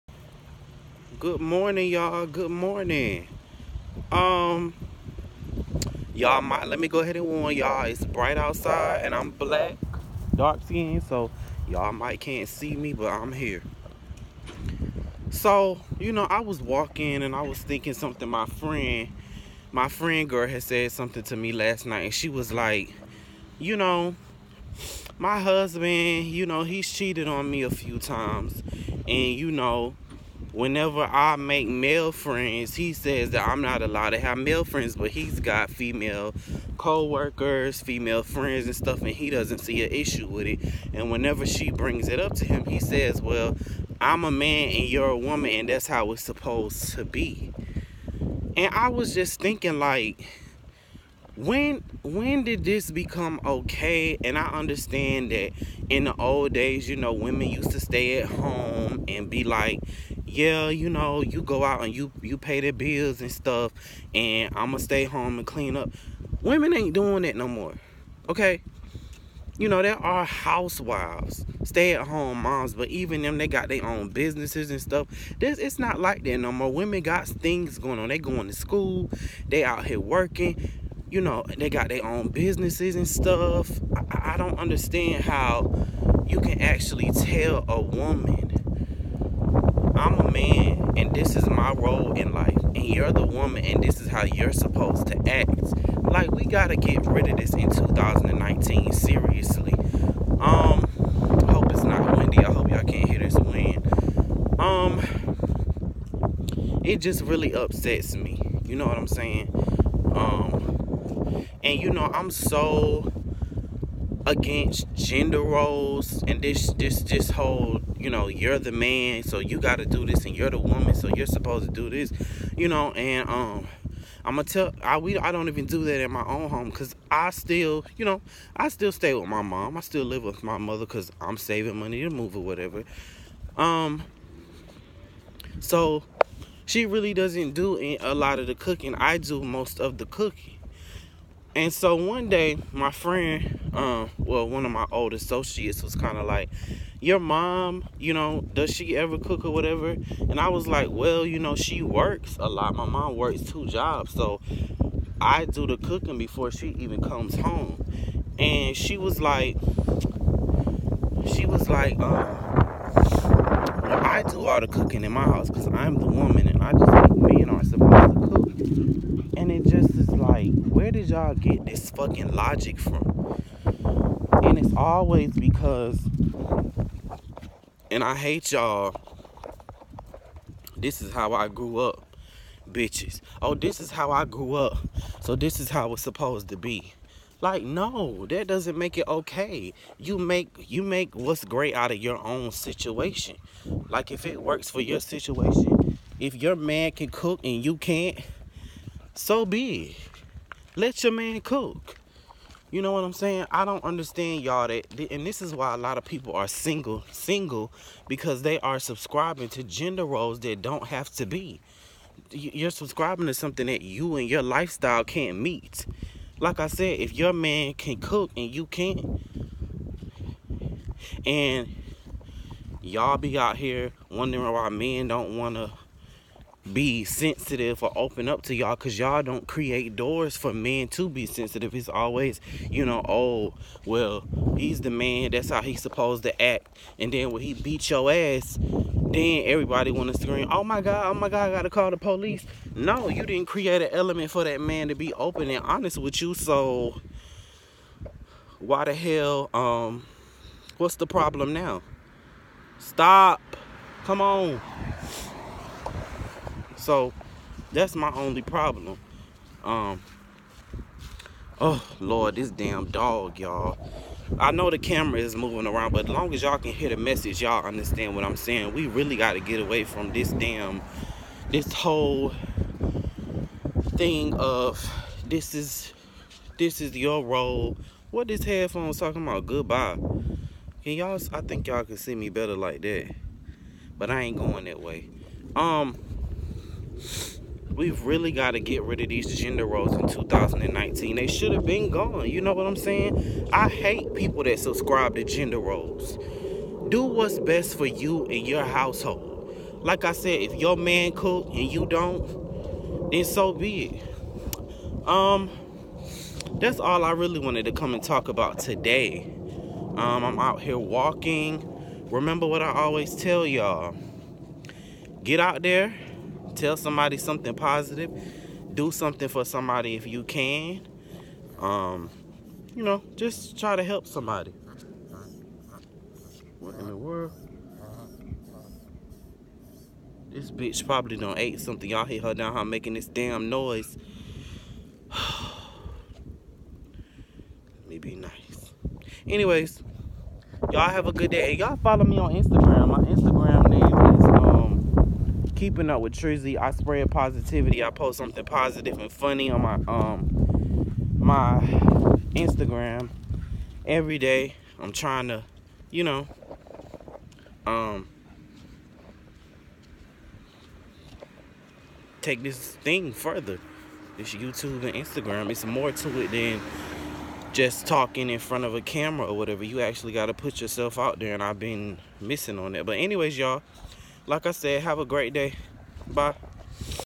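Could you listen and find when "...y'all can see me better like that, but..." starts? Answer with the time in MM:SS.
04:41.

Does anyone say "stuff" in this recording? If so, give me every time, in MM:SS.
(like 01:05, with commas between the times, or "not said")
00:38, 01:03, 01:14, 01:23.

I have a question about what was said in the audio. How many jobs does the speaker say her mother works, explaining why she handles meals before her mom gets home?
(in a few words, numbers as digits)
2.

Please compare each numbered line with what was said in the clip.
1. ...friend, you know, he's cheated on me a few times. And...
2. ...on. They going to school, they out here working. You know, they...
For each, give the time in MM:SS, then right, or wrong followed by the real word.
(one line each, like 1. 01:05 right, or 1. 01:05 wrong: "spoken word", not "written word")
1. 00:25 wrong: "husband", not "friend"
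2. 01:17 right.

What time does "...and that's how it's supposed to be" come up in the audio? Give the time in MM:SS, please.
00:45.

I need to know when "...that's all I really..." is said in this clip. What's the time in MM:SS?
05:06.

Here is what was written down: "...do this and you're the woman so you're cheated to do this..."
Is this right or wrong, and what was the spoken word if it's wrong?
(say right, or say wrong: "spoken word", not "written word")
wrong: "supposed", not "cheated".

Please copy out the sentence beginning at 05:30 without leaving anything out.
This bitch probably done ate something.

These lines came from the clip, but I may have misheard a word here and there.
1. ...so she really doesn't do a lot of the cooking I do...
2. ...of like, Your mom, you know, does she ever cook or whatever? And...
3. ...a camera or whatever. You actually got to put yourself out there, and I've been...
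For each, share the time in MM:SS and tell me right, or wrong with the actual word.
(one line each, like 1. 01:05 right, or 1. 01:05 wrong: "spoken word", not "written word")
1. 02:15 right
2. 02:26 right
3. 06:08 right.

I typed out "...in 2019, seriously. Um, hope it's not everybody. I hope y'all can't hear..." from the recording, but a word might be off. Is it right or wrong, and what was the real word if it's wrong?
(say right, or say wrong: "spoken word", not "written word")
wrong: "windy", not "everybody".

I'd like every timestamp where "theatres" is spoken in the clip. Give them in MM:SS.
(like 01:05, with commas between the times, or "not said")
not said.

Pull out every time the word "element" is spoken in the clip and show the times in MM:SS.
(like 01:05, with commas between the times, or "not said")
04:03.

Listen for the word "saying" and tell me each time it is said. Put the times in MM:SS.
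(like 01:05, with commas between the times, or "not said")
01:49, 03:23, 04:28, 04:52.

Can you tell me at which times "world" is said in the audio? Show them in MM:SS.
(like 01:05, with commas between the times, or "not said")
05:26.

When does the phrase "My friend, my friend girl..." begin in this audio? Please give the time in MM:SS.
00:18.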